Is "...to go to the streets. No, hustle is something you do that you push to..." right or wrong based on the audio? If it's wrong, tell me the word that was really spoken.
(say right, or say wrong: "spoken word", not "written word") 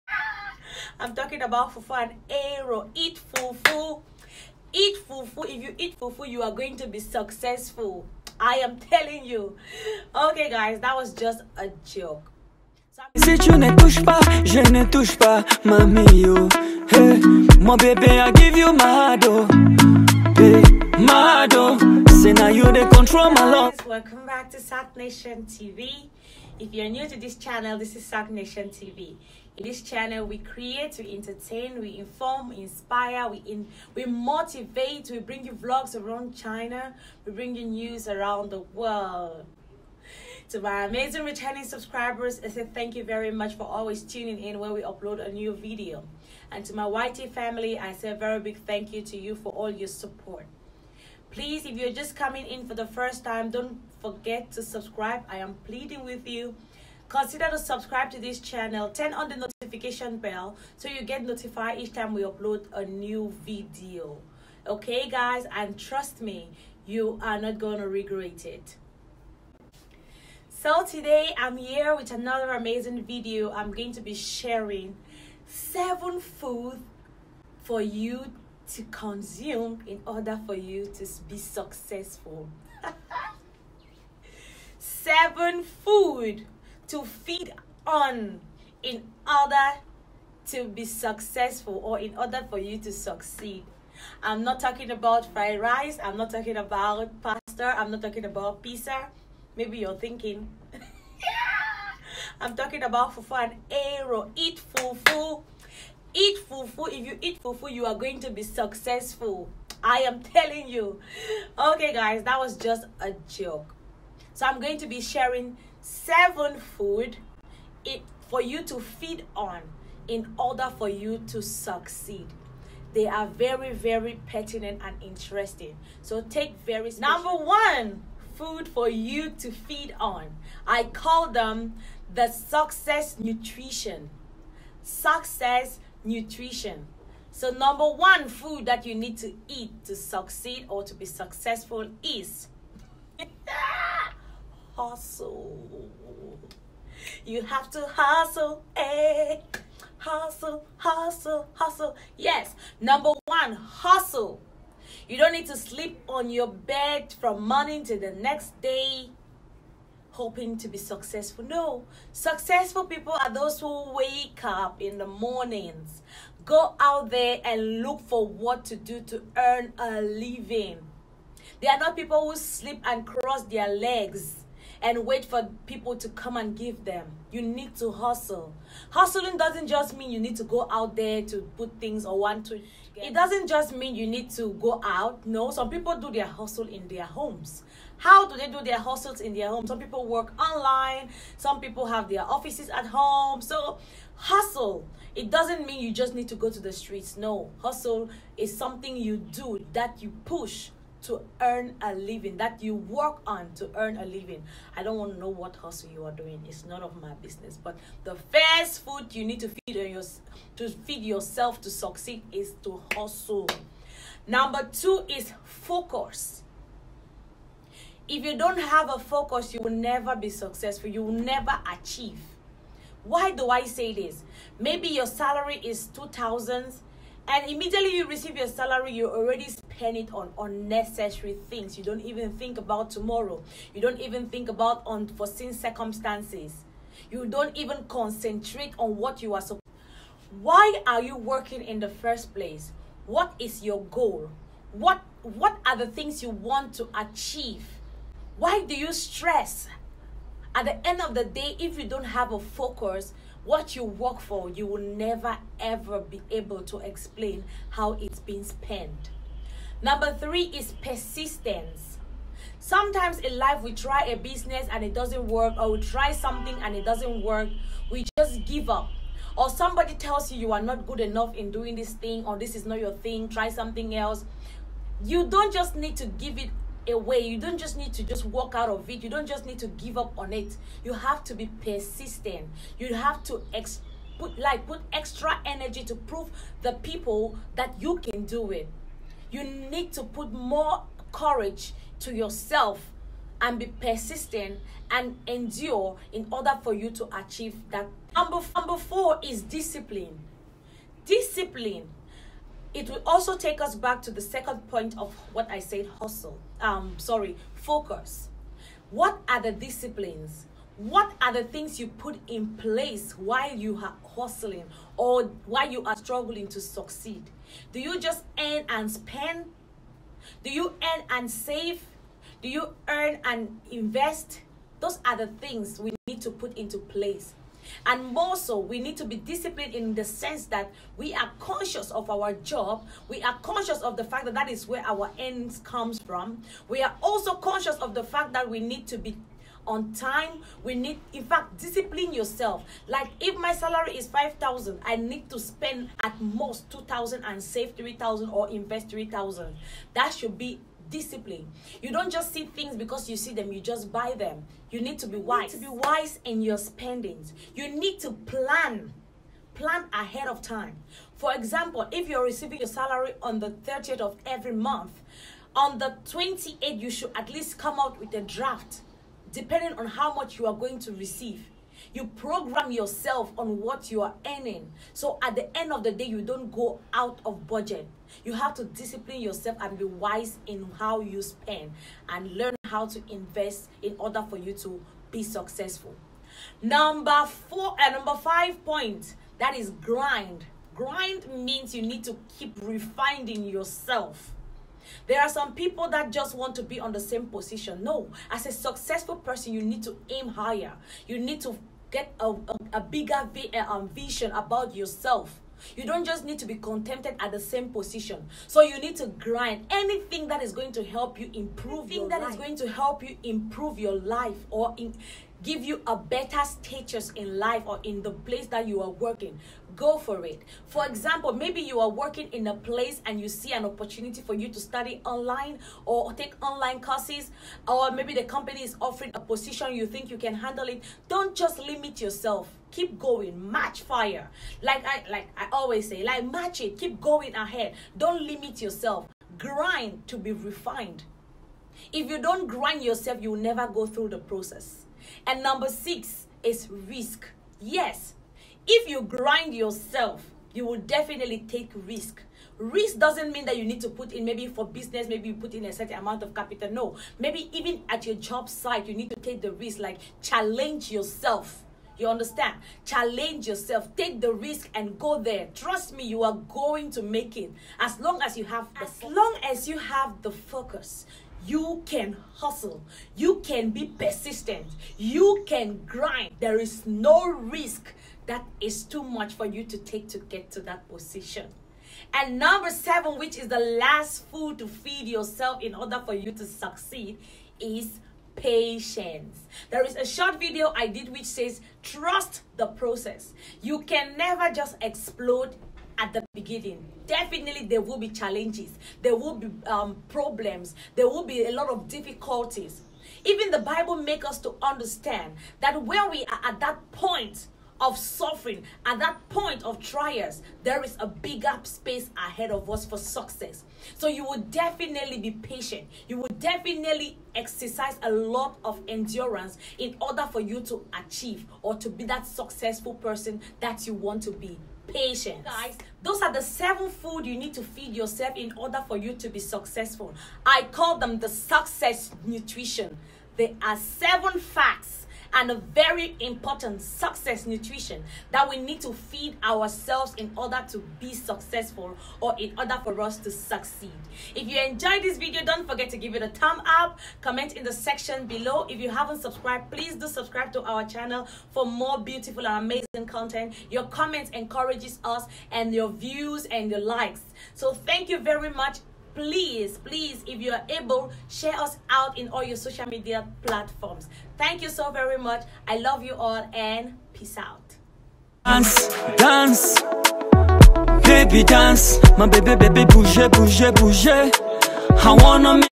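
right.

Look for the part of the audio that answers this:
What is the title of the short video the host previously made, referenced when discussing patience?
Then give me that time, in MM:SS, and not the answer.
08:11.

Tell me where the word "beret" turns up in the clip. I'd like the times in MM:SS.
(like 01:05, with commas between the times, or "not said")
not said.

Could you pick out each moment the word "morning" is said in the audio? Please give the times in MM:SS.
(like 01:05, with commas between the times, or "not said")
02:37, 02:45.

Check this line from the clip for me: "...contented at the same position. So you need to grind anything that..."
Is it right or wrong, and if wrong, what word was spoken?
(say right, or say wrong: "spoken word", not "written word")
right.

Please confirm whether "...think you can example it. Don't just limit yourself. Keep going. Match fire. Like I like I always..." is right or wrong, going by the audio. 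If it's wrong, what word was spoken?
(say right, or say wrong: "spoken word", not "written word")
wrong: "handle", not "example".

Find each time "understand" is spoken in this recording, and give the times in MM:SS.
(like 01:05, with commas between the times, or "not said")
07:42, 08:24.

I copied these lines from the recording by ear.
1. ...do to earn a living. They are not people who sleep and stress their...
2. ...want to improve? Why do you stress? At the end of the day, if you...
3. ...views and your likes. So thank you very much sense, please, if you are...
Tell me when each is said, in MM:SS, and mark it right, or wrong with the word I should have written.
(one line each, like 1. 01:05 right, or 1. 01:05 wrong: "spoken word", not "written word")
1. 02:48 wrong: "cross", not "stress"
2. 04:06 wrong: "achieve", not "improve"
3. 09:15 wrong: "please", not "sense".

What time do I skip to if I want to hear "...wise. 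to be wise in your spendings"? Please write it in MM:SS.
05:55.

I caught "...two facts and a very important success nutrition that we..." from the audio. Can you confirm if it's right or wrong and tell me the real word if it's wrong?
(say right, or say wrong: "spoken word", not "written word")
wrong: "seven", not "two".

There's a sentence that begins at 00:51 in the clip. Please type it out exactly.
Please, if you're just coming in for the first time, don't forget to subscribe.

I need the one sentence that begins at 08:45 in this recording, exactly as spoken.
Guys, those are the seven food you need to feed yourself in order for you to be successful.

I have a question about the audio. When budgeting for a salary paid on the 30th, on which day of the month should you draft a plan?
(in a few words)
the 28th.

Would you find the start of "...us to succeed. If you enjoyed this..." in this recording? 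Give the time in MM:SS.
09:03.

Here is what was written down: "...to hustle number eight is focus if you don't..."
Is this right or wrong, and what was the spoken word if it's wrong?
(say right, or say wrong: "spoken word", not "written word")
wrong: "two", not "eight".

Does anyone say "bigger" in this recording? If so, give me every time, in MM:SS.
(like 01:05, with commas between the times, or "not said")
06:42, 08:31.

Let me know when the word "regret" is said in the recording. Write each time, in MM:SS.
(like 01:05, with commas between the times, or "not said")
01:07.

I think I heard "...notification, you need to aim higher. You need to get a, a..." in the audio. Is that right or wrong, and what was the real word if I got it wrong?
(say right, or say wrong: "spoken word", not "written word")
wrong: "person", not "notification".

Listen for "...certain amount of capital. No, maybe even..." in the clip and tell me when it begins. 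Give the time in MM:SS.
07:35.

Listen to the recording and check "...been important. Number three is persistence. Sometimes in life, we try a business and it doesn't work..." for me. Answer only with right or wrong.
wrong.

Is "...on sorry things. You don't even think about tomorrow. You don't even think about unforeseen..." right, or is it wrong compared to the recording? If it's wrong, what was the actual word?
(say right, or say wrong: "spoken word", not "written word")
wrong: "unnecessary", not "sorry".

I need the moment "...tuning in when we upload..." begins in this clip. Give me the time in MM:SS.
00:44.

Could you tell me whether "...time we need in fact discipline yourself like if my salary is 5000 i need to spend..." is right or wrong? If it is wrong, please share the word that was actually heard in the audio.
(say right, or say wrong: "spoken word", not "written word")
right.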